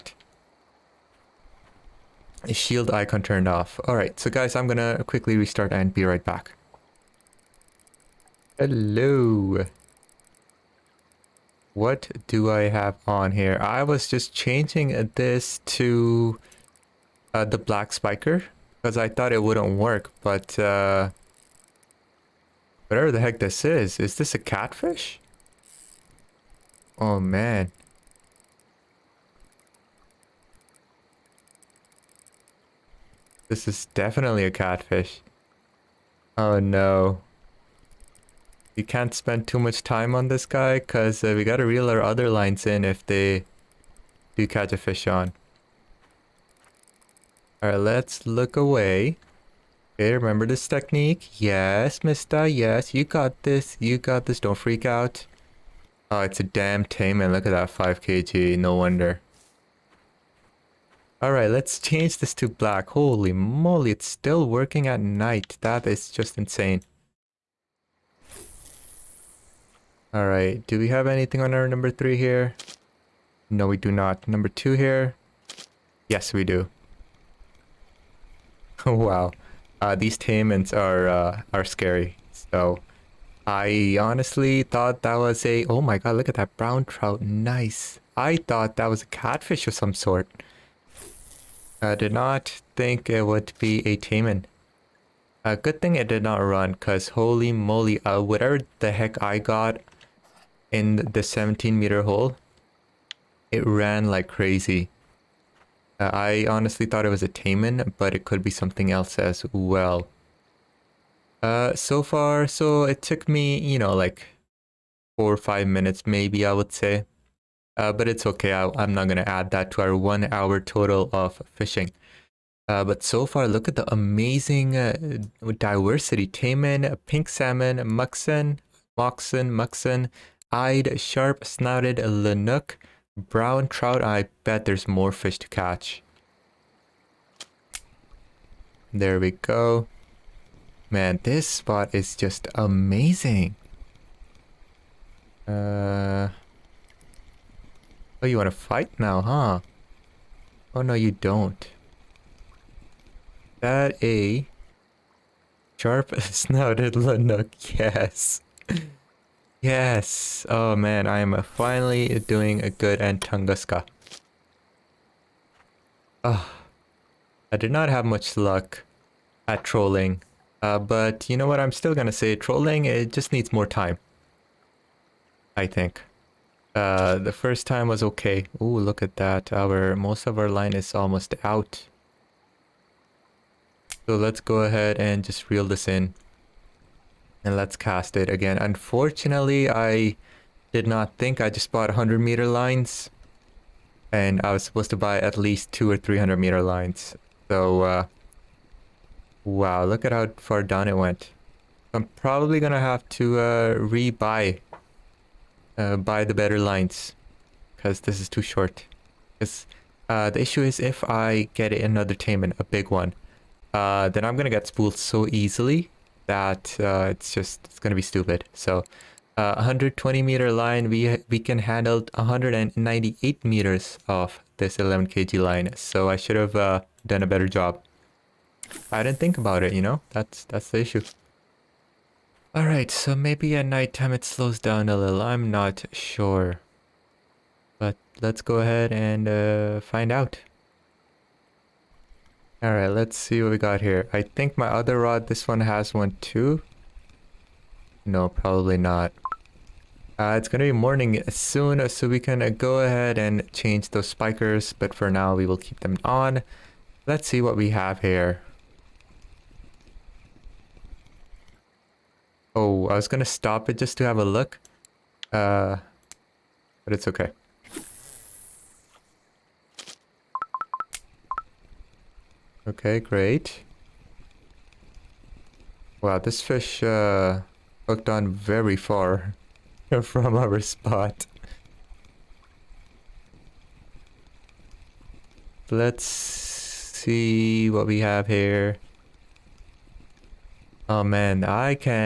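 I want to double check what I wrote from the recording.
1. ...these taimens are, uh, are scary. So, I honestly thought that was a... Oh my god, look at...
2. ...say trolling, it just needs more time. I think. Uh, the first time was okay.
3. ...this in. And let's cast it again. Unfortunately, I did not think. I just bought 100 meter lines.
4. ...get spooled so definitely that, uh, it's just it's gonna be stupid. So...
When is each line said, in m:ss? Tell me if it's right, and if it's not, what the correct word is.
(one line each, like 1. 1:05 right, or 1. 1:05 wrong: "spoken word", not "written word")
1. 1:19 right
2. 2:52 right
3. 3:05 right
4. 3:34 wrong: "easily", not "definitely".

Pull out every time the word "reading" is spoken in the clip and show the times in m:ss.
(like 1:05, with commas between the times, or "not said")
not said.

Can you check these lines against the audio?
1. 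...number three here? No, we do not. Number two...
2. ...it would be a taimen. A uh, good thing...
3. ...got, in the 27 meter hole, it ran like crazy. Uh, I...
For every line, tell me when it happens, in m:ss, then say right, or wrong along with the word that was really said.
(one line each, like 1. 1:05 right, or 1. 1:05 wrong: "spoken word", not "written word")
1. 1:11 right
2. 1:33 right
3. 1:39 wrong: "17", not "27".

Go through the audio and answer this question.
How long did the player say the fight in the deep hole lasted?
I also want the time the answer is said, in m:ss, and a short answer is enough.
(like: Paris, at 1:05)
four or five minutes, at 1:55.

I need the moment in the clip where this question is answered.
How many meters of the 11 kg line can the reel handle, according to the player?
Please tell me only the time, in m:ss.
3:42.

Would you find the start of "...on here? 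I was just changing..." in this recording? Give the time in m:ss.
0:13.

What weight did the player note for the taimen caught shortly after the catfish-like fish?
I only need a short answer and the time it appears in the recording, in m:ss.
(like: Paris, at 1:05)
5kg, at 0:57.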